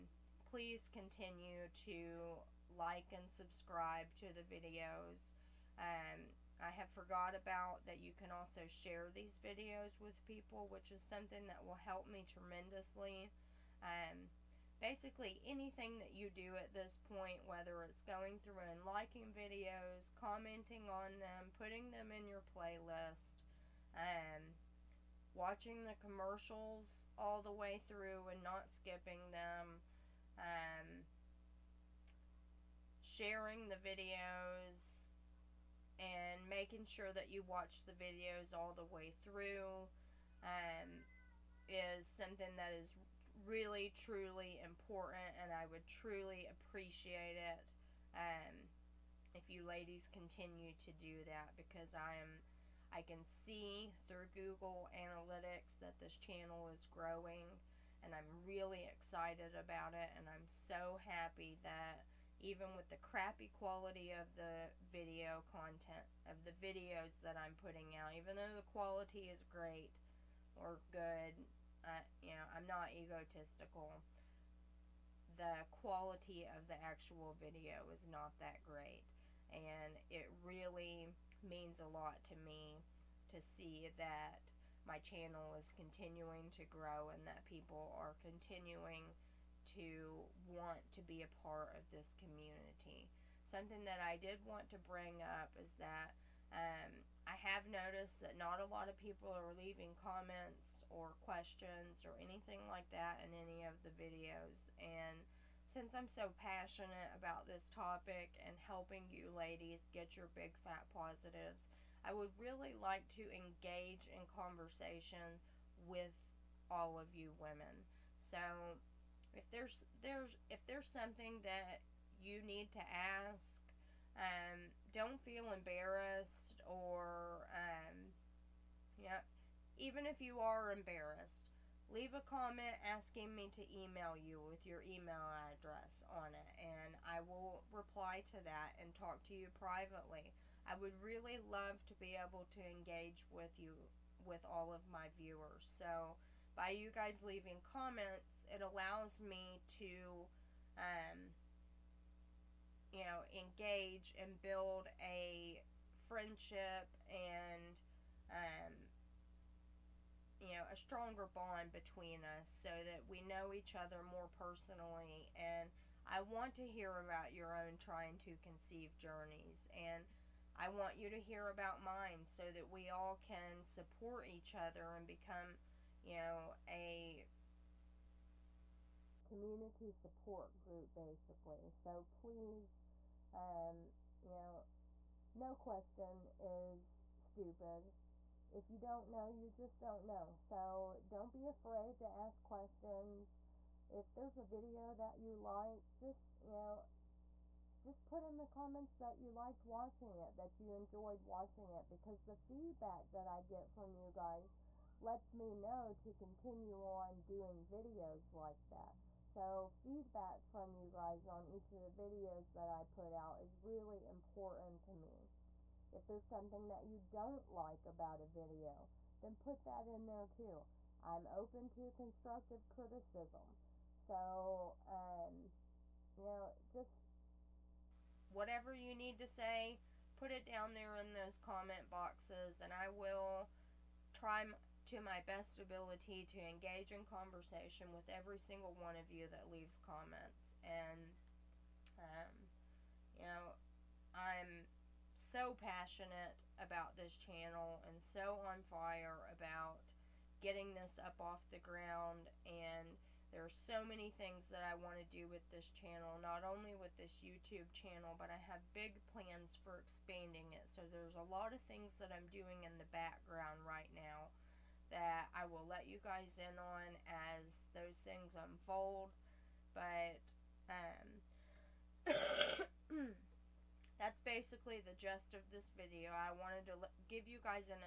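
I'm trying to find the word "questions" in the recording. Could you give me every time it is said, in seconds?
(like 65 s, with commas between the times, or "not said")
101 s, 185 s, 192 s.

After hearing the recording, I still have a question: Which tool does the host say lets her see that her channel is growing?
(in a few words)
Google Analytics.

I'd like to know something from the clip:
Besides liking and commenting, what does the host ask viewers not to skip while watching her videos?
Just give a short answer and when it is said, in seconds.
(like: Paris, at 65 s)
the commercials, at 26 s.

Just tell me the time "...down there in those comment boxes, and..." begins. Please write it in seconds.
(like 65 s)
230 s.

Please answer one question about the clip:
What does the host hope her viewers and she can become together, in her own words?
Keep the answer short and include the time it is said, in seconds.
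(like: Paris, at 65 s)
a community support group, at 179 s.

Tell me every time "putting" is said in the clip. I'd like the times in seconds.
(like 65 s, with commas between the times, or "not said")
21 s, 67 s.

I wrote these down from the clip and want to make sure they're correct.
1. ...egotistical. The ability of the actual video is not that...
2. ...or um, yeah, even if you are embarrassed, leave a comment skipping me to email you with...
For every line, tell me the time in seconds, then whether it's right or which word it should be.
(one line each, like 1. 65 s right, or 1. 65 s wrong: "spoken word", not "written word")
1. 72 s wrong: "quality", not "ability"
2. 126 s wrong: "asking", not "skipping".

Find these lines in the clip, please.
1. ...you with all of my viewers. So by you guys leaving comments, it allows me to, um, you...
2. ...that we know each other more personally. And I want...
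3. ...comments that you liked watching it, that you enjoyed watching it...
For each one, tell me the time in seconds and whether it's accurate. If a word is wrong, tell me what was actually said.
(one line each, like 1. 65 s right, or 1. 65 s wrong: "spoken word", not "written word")
1. 143 s right
2. 162 s right
3. 198 s right.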